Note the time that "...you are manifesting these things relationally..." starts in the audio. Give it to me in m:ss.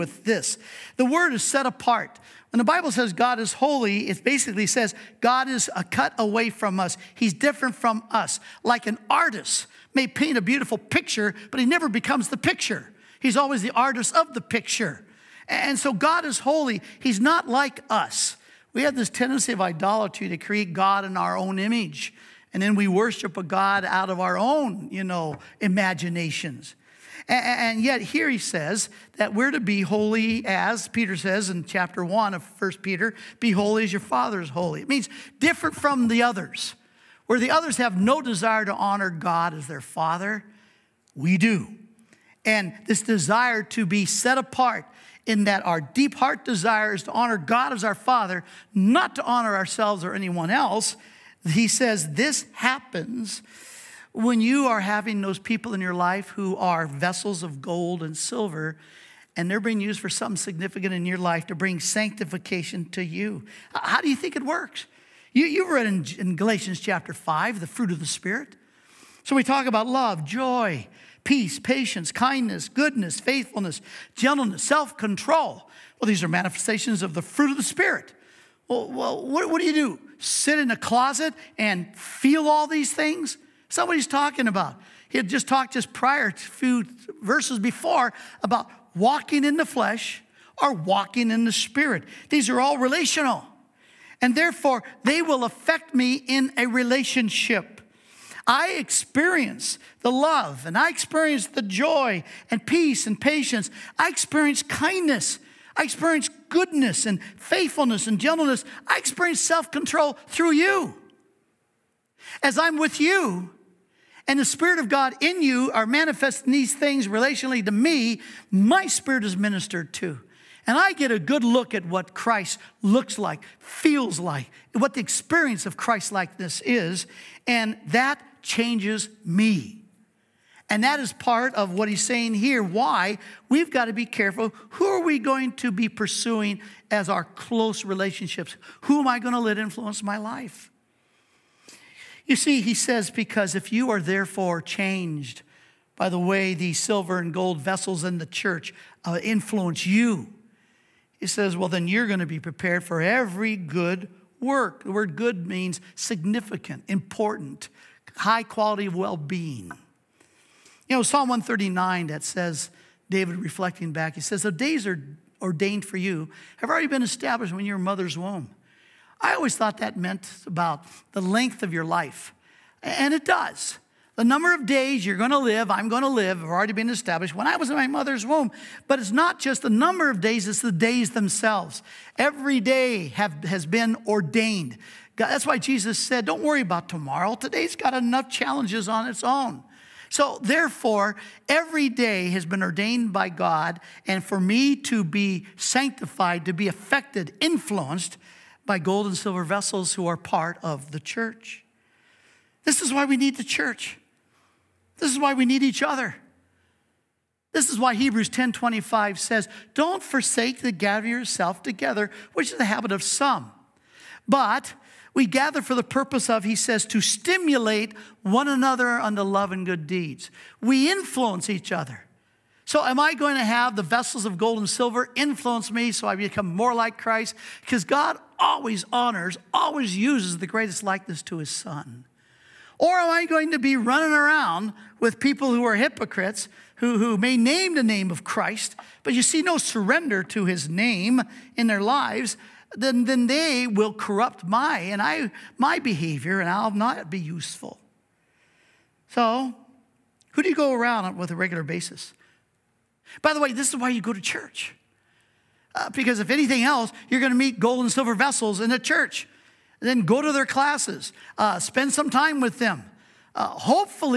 1:55.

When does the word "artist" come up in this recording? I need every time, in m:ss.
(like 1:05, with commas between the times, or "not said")
0:09, 0:13.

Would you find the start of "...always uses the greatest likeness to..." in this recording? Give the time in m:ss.
3:49.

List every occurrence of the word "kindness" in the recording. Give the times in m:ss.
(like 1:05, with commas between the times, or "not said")
1:12, 1:44.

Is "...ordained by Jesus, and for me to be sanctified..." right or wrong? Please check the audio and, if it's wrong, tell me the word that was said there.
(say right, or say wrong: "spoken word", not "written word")
wrong: "God", not "Jesus".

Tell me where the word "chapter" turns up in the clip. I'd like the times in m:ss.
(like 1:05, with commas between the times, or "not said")
0:31, 1:06.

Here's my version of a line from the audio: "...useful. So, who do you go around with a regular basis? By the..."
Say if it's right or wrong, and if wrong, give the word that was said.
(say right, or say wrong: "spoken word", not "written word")
right.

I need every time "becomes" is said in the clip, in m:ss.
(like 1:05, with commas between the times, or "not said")
0:11, 3:46.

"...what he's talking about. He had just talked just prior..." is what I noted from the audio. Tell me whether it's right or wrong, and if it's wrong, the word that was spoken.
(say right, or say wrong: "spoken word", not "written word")
right.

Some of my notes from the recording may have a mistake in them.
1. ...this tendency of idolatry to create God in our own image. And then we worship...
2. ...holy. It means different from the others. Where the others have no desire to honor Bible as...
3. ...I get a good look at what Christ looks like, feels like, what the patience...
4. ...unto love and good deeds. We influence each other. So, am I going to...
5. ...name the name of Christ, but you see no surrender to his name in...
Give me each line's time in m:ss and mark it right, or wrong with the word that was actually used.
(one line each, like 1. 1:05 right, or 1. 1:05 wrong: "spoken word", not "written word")
1. 0:18 right
2. 0:34 wrong: "God", not "Bible"
3. 2:00 wrong: "experience", not "patience"
4. 3:38 right
5. 3:57 right.